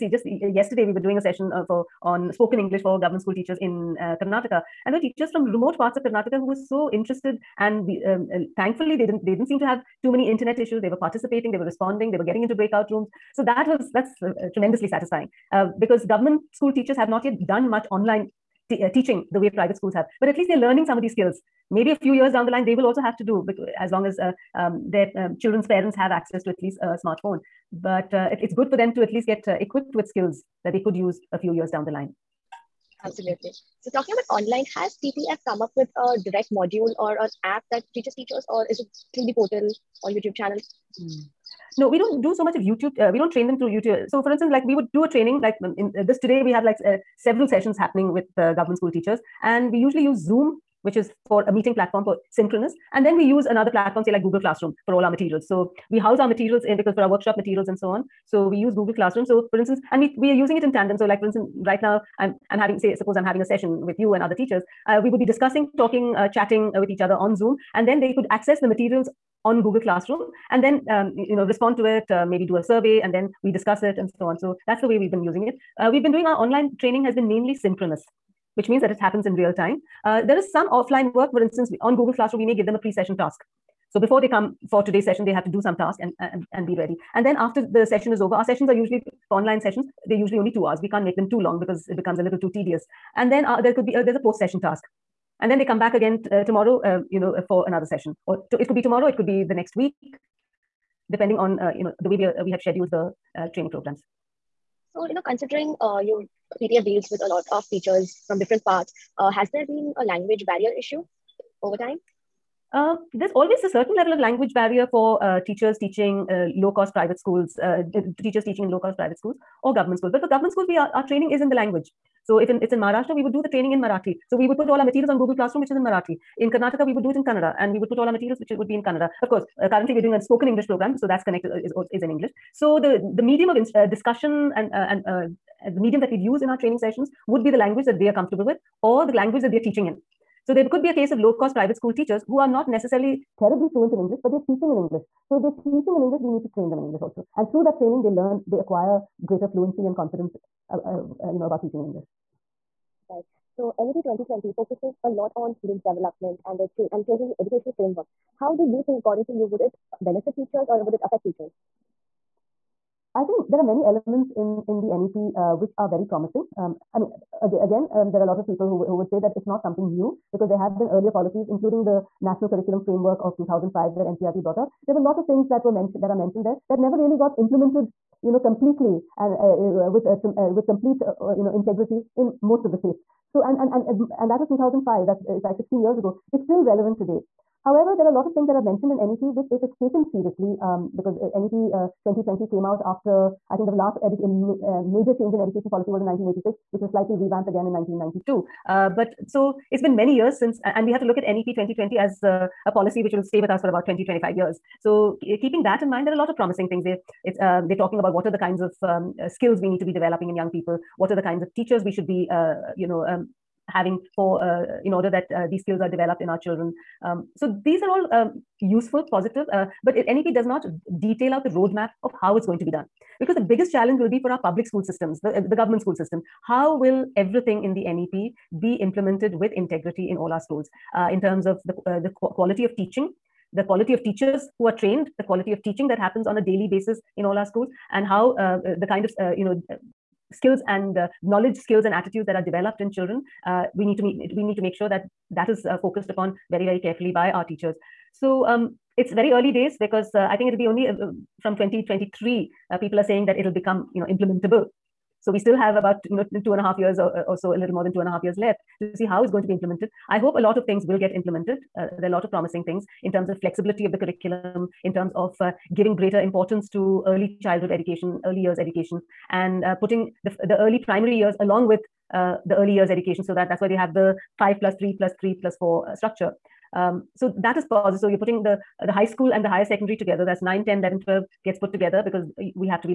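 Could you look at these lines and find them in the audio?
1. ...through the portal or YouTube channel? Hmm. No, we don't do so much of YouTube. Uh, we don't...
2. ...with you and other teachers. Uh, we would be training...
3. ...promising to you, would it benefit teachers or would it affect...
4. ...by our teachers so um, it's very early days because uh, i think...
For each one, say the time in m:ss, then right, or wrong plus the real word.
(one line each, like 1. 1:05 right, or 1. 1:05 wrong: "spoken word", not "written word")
1. 0:39 right
2. 1:03 wrong: "discussing", not "training"
3. 2:39 wrong: "according", not "promising"
4. 4:07 right.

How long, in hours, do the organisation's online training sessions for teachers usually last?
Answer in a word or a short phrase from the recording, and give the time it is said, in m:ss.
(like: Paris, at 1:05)
2, at 1:30.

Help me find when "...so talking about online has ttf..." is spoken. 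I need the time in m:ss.
0:33.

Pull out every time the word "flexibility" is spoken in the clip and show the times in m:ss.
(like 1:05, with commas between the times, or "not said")
4:23.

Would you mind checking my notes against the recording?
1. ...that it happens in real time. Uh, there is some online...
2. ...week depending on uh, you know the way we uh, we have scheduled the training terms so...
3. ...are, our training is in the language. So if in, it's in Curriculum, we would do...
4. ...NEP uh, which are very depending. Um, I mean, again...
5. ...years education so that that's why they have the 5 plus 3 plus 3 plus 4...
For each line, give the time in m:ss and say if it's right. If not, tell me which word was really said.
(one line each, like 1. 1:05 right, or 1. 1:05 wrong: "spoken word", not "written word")
1. 1:18 wrong: "offline", not "online"
2. 1:39 wrong: "programs", not "terms"
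3. 2:00 wrong: "Maharashtra", not "Curriculum"
4. 2:44 wrong: "promising", not "depending"
5. 4:32 right.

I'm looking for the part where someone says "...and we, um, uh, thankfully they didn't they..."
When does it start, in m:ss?
0:07.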